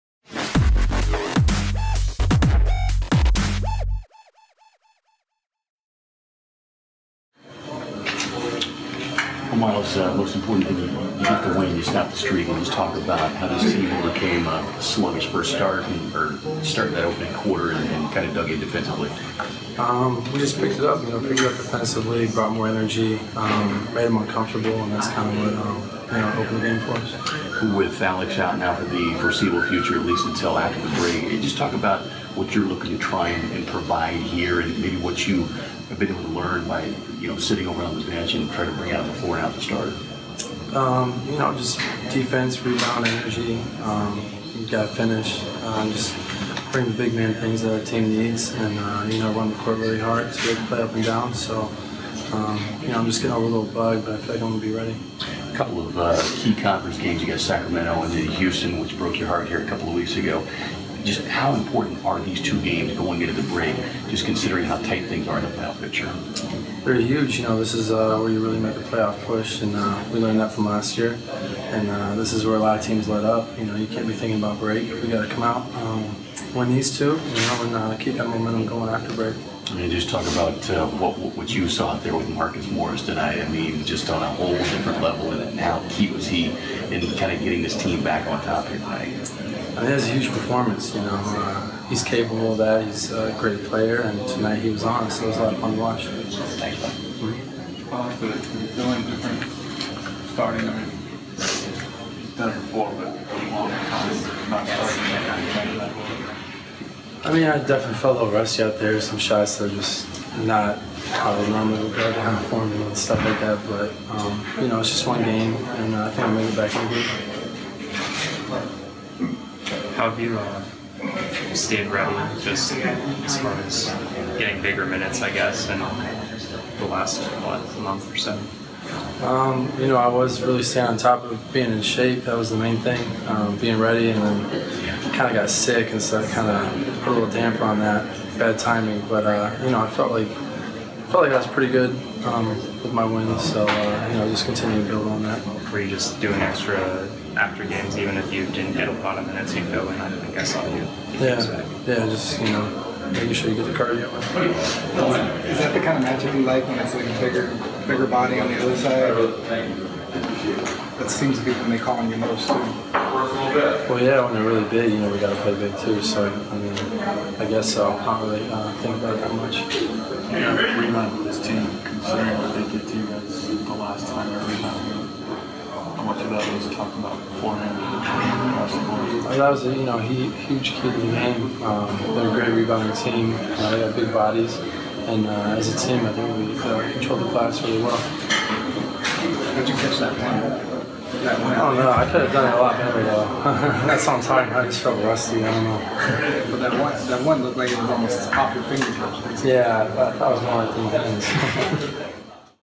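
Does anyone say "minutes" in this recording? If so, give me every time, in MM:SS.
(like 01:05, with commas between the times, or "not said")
02:04, 02:29.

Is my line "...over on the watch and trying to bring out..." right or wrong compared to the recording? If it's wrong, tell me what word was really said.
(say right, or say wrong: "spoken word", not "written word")
wrong: "bench", not "watch".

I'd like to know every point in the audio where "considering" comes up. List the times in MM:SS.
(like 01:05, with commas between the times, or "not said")
01:04, 02:51.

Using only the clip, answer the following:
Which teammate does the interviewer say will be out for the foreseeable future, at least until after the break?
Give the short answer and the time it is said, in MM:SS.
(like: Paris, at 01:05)
Alex, at 00:28.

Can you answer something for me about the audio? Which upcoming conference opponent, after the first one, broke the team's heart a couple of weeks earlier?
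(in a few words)
Houston.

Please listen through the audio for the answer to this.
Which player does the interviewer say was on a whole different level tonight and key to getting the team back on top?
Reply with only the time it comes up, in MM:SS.
01:22.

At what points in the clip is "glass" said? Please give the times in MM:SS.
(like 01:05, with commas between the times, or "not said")
03:07.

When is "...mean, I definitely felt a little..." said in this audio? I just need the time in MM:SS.
01:47.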